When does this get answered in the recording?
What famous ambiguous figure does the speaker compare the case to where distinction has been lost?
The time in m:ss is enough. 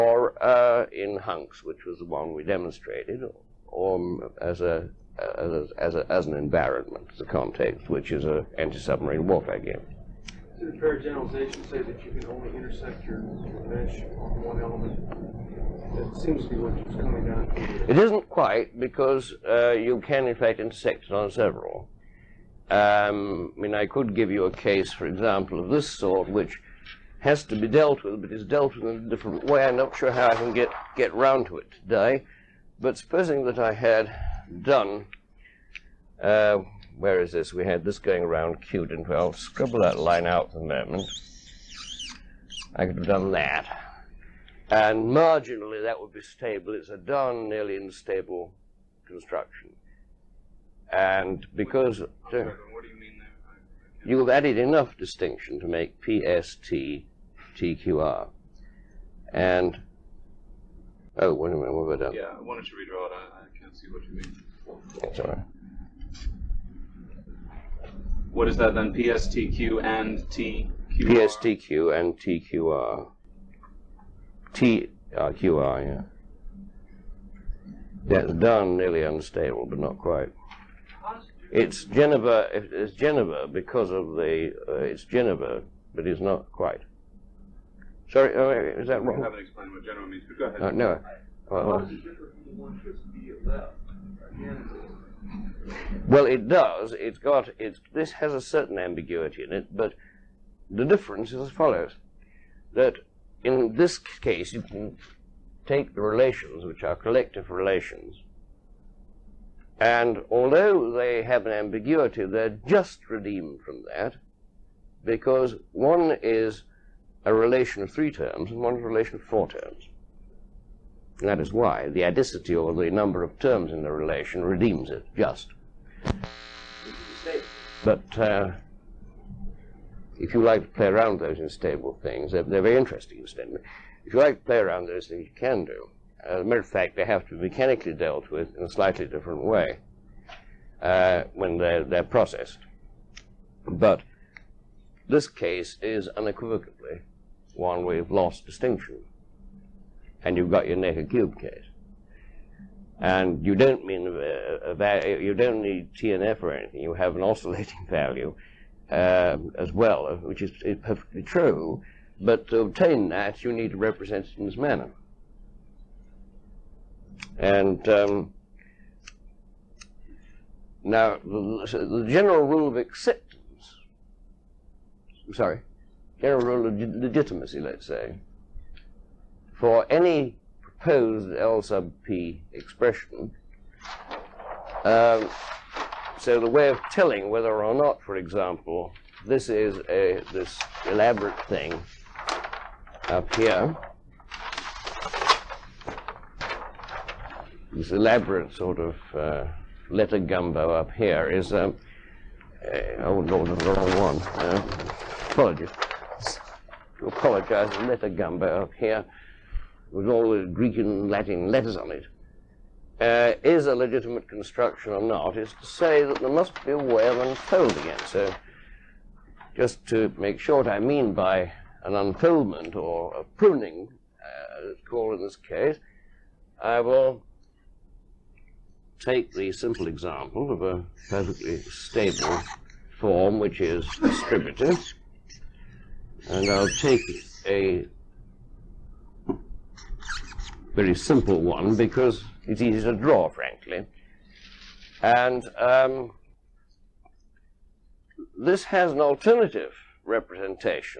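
2:30.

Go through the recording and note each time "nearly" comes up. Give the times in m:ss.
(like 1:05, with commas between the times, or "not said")
0:47, 1:18.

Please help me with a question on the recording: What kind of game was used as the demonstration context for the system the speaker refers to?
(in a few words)
Anti-submarine warfare game.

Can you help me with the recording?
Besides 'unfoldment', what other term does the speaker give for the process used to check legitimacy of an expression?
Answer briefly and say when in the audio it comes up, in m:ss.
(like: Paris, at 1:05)
Pruning, at 3:43.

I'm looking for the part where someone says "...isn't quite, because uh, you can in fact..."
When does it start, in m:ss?
0:17.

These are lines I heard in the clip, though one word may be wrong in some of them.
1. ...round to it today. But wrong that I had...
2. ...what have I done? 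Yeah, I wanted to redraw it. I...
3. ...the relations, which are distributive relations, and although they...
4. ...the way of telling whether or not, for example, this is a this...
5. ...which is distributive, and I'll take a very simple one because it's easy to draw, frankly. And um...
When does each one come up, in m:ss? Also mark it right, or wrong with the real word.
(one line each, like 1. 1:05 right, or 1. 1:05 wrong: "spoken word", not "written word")
1. 0:31 wrong: "supposing", not "wrong"
2. 1:01 right
3. 1:45 wrong: "collective", not "distributive"
4. 3:06 right
5. 3:53 right.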